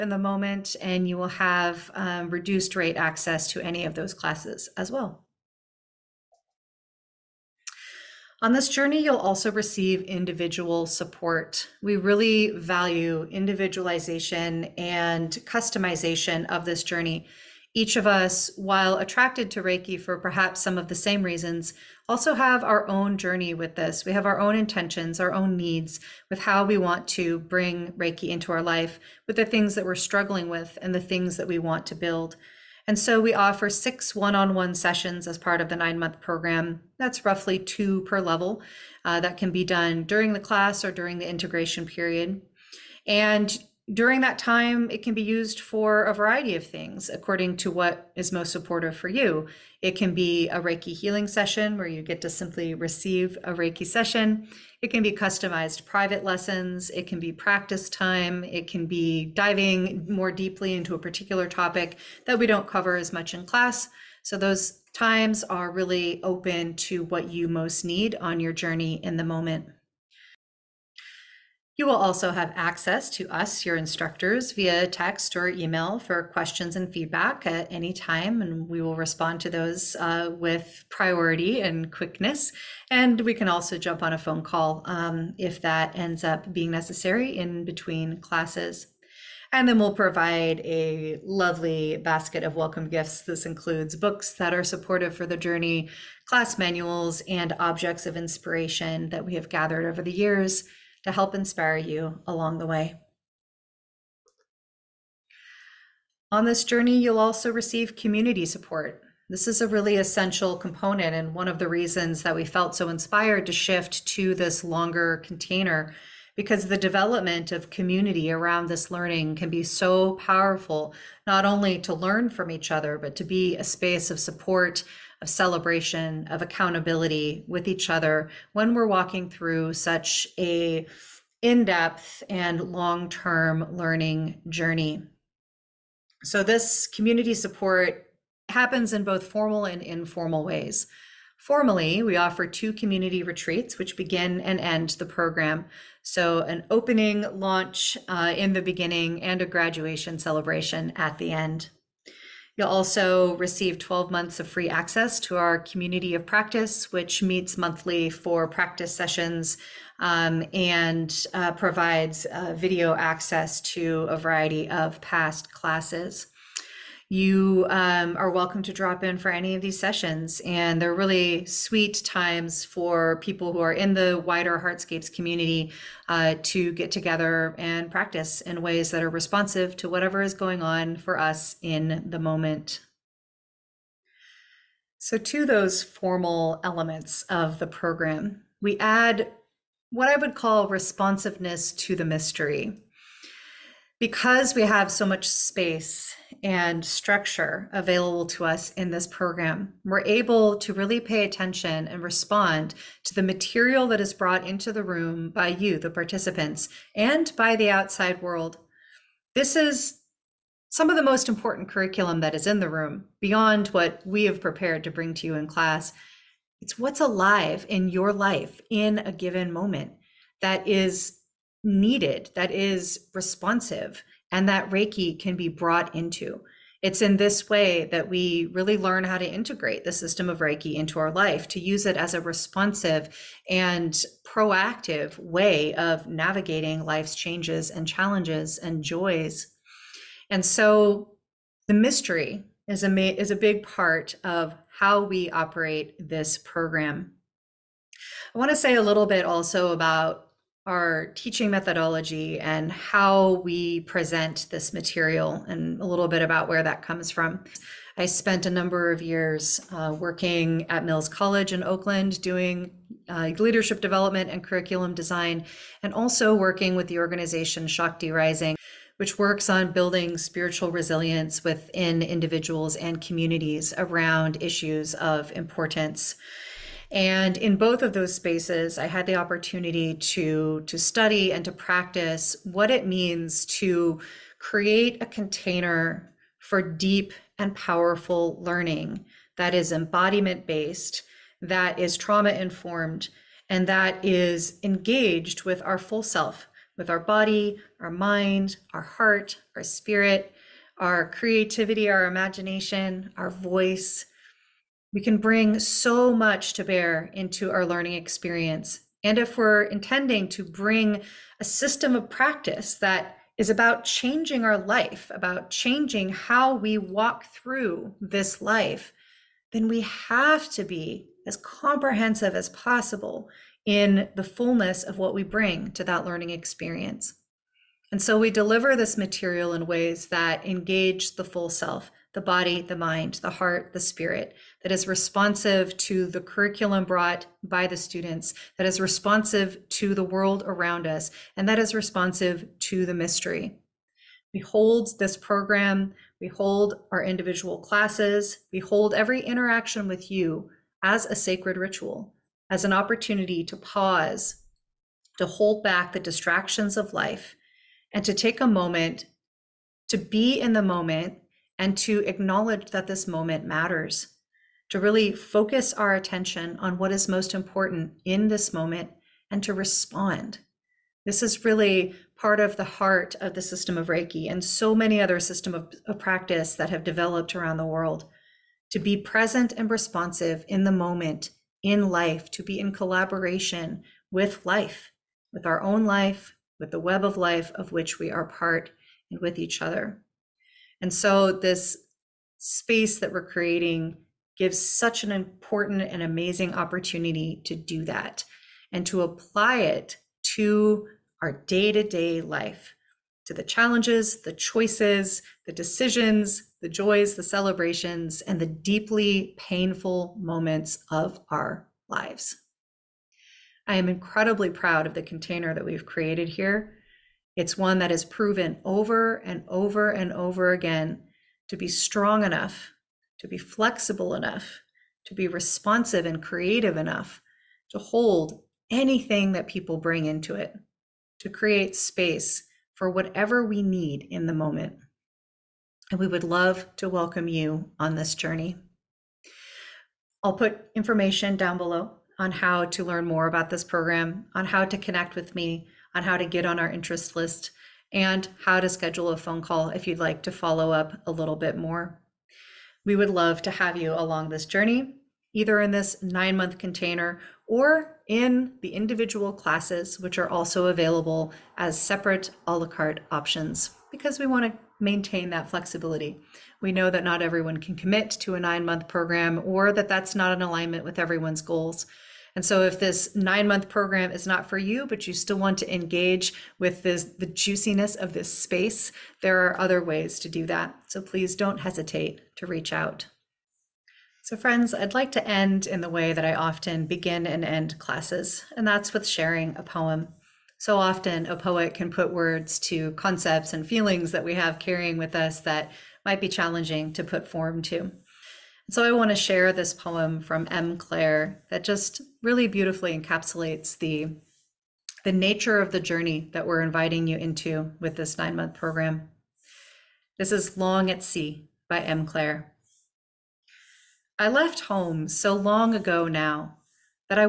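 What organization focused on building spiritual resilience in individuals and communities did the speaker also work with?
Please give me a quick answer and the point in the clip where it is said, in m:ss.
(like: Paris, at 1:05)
Shakti Rising, at 4:27.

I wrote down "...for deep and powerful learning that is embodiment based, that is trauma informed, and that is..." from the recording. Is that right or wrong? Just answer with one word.
right.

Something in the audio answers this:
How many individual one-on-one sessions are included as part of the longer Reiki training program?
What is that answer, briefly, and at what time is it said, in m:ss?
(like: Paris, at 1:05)
6, at 0:33.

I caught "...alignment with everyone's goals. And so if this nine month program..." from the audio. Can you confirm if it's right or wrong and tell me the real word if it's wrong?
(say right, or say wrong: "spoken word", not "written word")
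right.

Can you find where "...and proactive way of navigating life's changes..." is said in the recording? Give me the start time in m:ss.
3:53.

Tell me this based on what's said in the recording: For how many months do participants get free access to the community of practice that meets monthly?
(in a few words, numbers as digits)
12.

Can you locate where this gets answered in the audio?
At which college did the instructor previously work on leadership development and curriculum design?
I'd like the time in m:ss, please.
4:20.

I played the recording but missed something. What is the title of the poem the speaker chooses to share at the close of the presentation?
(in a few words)
Long at Sea.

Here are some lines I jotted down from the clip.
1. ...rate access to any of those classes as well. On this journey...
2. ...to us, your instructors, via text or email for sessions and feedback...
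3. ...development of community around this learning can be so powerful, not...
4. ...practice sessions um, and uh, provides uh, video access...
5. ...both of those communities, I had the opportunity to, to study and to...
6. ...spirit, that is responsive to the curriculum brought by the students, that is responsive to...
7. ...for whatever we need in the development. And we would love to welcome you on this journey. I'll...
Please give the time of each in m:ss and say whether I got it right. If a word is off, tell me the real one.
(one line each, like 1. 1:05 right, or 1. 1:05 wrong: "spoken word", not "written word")
1. 0:02 right
2. 1:13 wrong: "questions", not "sessions"
3. 1:56 right
4. 2:38 right
5. 4:37 wrong: "spaces", not "communities"
6. 5:33 right
7. 7:12 wrong: "moment", not "development".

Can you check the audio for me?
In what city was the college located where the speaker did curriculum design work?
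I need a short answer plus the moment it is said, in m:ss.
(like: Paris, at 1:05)
Oakland, at 4:21.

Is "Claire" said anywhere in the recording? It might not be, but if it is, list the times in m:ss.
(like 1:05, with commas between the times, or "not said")
8:20, 8:32.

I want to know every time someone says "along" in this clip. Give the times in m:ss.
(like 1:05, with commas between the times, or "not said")
1:42, 7:33.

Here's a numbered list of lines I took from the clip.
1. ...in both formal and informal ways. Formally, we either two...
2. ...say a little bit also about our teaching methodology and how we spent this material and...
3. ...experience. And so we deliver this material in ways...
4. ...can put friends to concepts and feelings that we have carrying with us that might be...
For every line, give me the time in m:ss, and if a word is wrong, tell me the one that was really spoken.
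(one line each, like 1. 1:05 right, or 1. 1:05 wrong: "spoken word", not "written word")
1. 2:18 wrong: "offer", not "either"
2. 4:08 wrong: "present", not "spent"
3. 5:26 right
4. 8:11 wrong: "words", not "friends".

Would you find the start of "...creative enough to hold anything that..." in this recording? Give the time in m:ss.
7:06.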